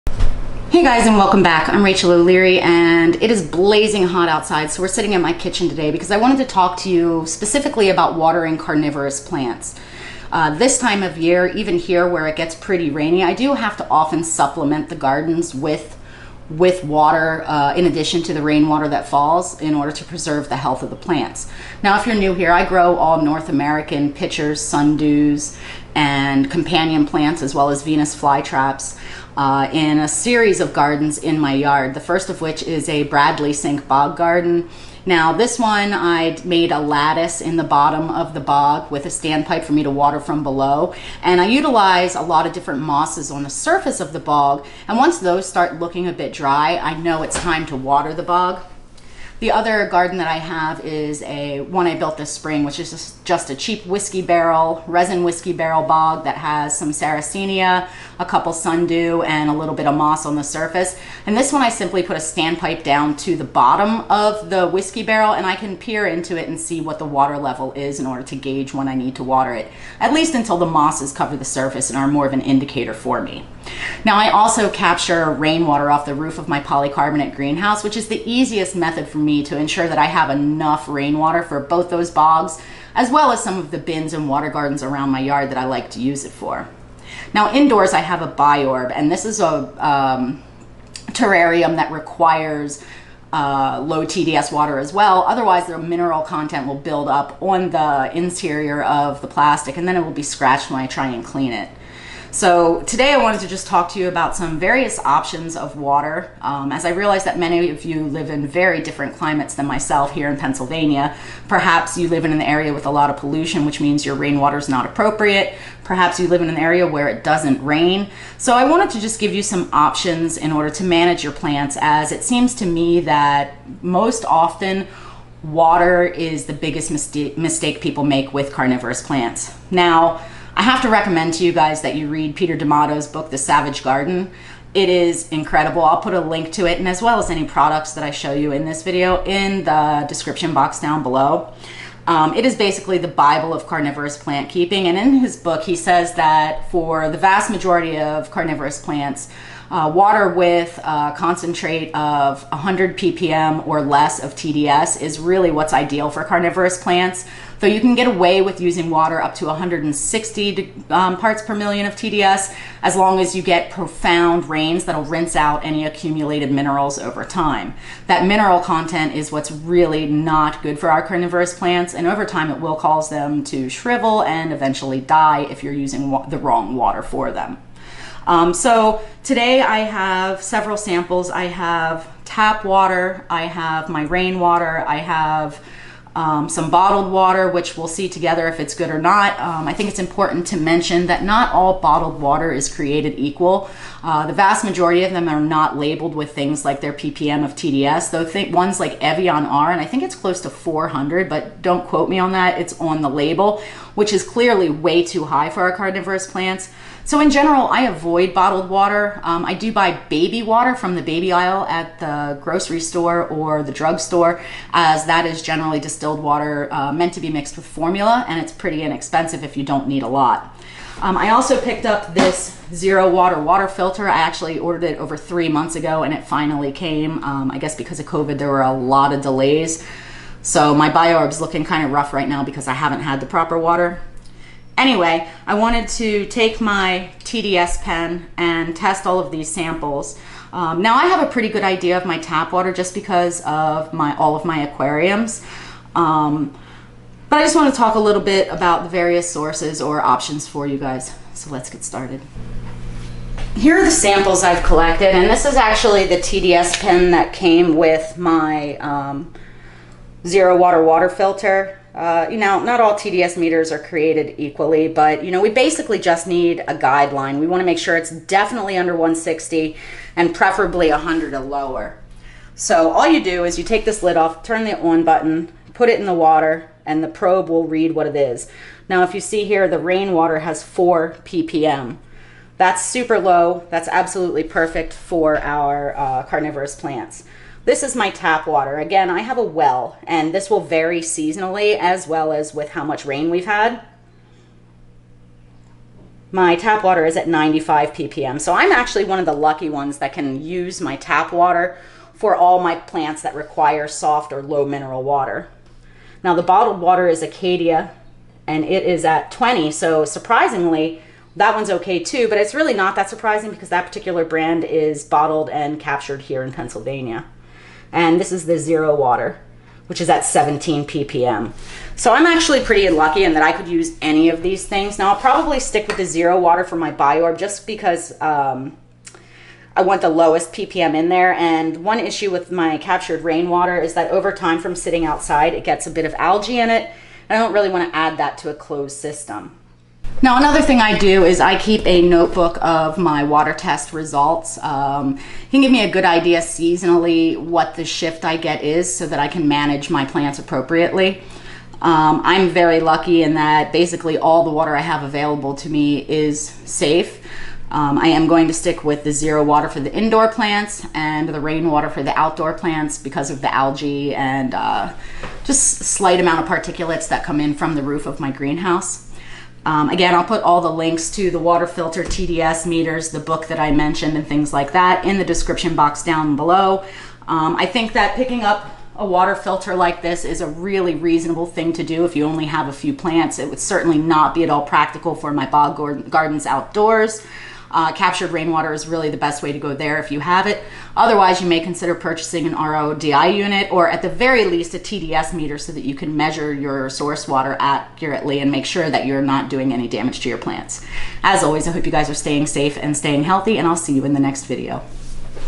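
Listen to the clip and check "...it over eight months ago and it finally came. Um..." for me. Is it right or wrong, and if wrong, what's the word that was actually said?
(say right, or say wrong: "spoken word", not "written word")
wrong: "three", not "eight".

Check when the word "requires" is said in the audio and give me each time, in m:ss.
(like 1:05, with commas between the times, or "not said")
1:31, 5:03.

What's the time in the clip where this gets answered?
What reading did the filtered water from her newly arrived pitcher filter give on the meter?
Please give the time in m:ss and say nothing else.
5:20.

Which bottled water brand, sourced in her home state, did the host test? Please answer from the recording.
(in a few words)
Acadia.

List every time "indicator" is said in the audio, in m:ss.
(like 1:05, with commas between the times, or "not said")
1:12.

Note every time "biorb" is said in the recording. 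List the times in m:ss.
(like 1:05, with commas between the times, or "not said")
1:28, 3:50, 5:26.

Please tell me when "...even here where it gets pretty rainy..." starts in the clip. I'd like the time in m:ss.
0:11.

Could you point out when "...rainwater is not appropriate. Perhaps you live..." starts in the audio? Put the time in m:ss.
1:54.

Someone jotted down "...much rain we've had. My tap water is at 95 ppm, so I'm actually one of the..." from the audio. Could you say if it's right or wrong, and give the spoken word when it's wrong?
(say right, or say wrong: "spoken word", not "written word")
right.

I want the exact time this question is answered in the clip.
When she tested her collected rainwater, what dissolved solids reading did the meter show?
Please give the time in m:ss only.
4:40.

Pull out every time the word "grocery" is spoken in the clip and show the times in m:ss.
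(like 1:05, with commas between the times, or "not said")
3:32.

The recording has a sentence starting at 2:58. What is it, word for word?
Um, so today I have several samples.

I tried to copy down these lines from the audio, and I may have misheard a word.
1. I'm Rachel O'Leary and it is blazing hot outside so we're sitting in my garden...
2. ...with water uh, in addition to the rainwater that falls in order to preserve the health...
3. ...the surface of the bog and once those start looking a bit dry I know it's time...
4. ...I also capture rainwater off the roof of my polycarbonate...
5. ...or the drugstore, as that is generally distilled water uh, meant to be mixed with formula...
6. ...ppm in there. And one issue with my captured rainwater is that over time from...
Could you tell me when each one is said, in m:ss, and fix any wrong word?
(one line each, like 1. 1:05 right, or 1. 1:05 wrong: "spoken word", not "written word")
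1. 0:01 wrong: "kitchen", not "garden"
2. 0:16 right
3. 0:43 right
4. 1:14 right
5. 3:33 right
6. 5:30 right.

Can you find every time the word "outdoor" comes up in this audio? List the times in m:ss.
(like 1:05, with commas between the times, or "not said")
6:02, 6:26.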